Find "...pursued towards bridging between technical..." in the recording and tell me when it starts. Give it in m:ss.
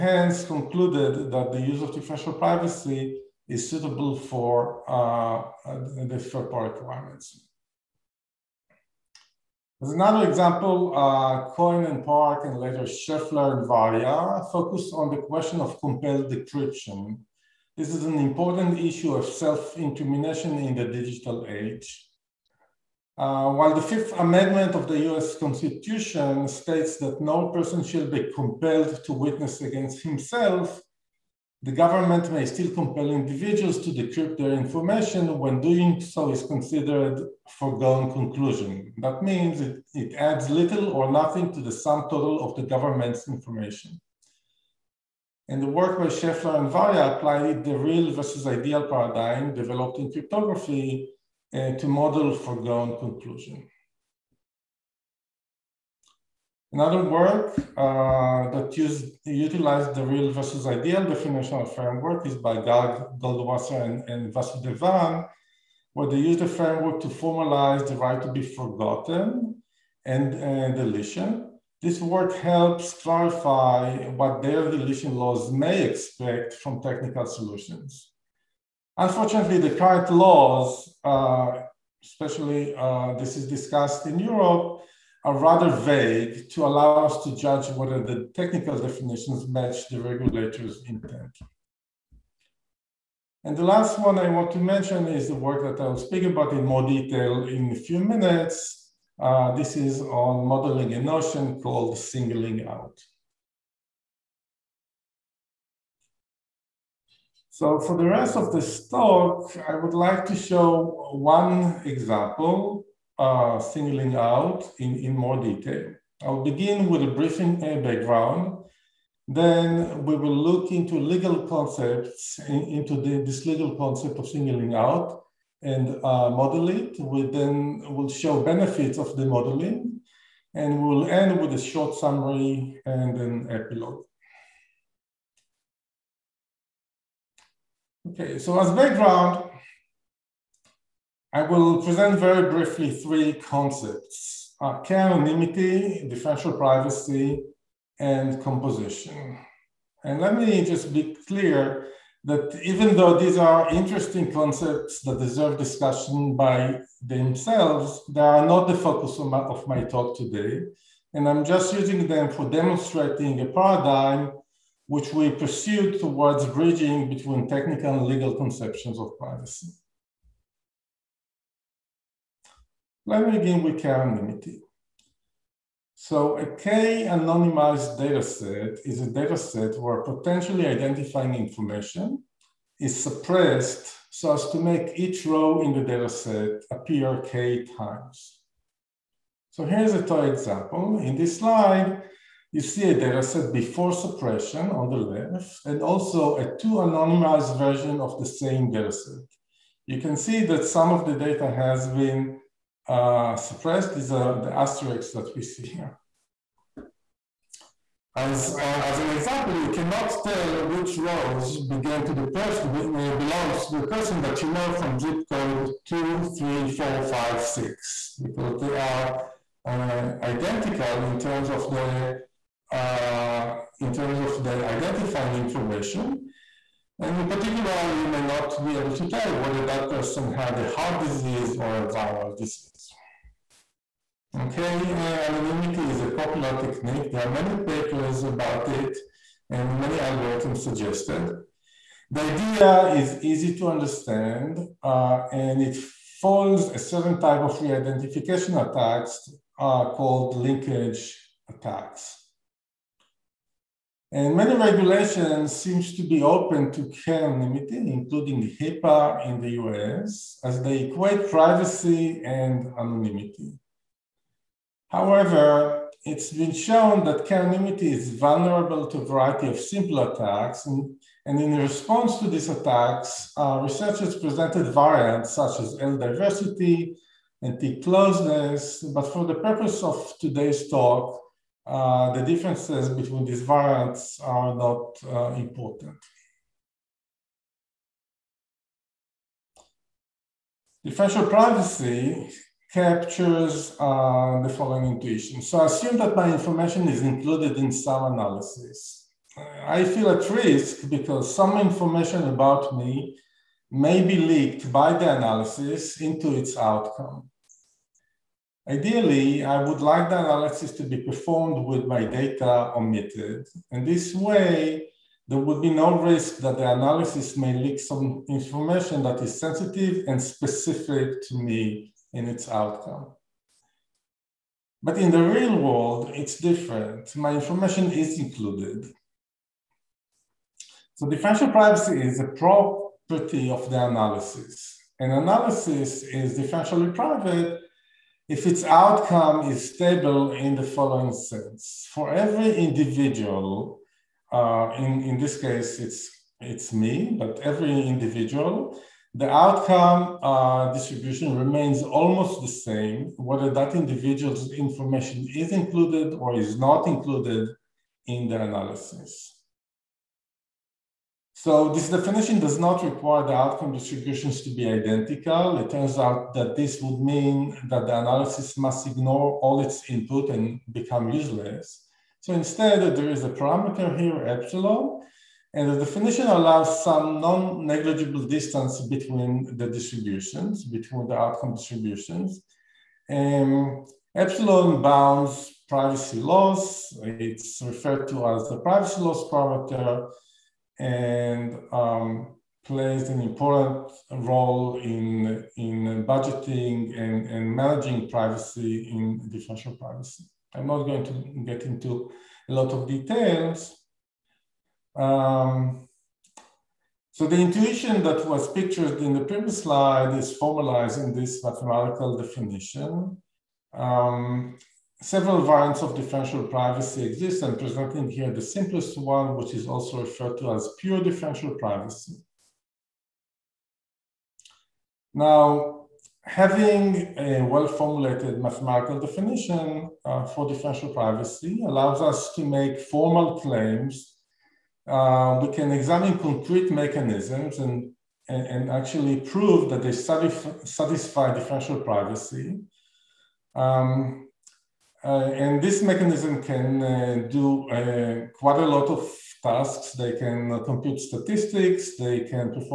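2:45.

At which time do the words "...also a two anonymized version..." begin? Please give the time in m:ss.
3:15.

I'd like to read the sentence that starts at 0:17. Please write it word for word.
This is an important issue of self-incrimination in the digital age.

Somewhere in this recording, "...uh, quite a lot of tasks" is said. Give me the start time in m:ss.
7:27.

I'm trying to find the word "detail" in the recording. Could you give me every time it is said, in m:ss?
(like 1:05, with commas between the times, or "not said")
1:36, 1:55, 6:42.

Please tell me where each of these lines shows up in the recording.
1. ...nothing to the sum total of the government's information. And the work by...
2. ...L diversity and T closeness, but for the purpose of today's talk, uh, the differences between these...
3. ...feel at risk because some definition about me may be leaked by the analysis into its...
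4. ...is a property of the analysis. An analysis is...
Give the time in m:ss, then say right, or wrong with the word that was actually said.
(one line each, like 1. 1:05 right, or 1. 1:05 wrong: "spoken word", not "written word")
1. 0:41 right
2. 4:35 right
3. 4:59 wrong: "information", not "definition"
4. 5:31 right.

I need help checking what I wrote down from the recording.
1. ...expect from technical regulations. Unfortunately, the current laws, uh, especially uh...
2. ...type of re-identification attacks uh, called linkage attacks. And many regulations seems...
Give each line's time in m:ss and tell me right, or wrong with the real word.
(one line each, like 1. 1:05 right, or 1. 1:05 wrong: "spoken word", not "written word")
1. 1:15 wrong: "solutions", not "regulations"
2. 4:07 right.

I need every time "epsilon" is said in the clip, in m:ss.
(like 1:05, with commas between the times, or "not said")
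6:14, 6:24.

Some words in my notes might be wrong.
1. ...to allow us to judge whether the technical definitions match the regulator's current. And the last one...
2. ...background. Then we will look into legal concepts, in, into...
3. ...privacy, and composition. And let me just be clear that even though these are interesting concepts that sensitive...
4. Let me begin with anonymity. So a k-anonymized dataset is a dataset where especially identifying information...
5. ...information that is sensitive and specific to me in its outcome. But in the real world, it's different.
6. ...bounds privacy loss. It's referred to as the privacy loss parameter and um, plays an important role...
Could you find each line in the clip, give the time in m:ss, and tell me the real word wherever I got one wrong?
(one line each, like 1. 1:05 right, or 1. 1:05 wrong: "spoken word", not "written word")
1. 1:26 wrong: "intent", not "current"
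2. 1:57 right
3. 2:26 wrong: "deserve", not "sensitive"
4. 2:53 wrong: "potentially", not "especially"
5. 5:18 right
6. 6:24 right.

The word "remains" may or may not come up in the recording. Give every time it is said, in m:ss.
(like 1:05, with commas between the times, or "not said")
5:51.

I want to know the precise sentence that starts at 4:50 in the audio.
Differential privacy captures uh, the following intuition.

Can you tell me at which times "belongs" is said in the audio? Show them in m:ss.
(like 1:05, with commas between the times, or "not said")
3:33.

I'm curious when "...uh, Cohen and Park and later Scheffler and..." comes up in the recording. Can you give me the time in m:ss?
0:10.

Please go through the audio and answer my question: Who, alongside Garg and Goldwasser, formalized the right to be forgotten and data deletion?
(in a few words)
Vasudevan.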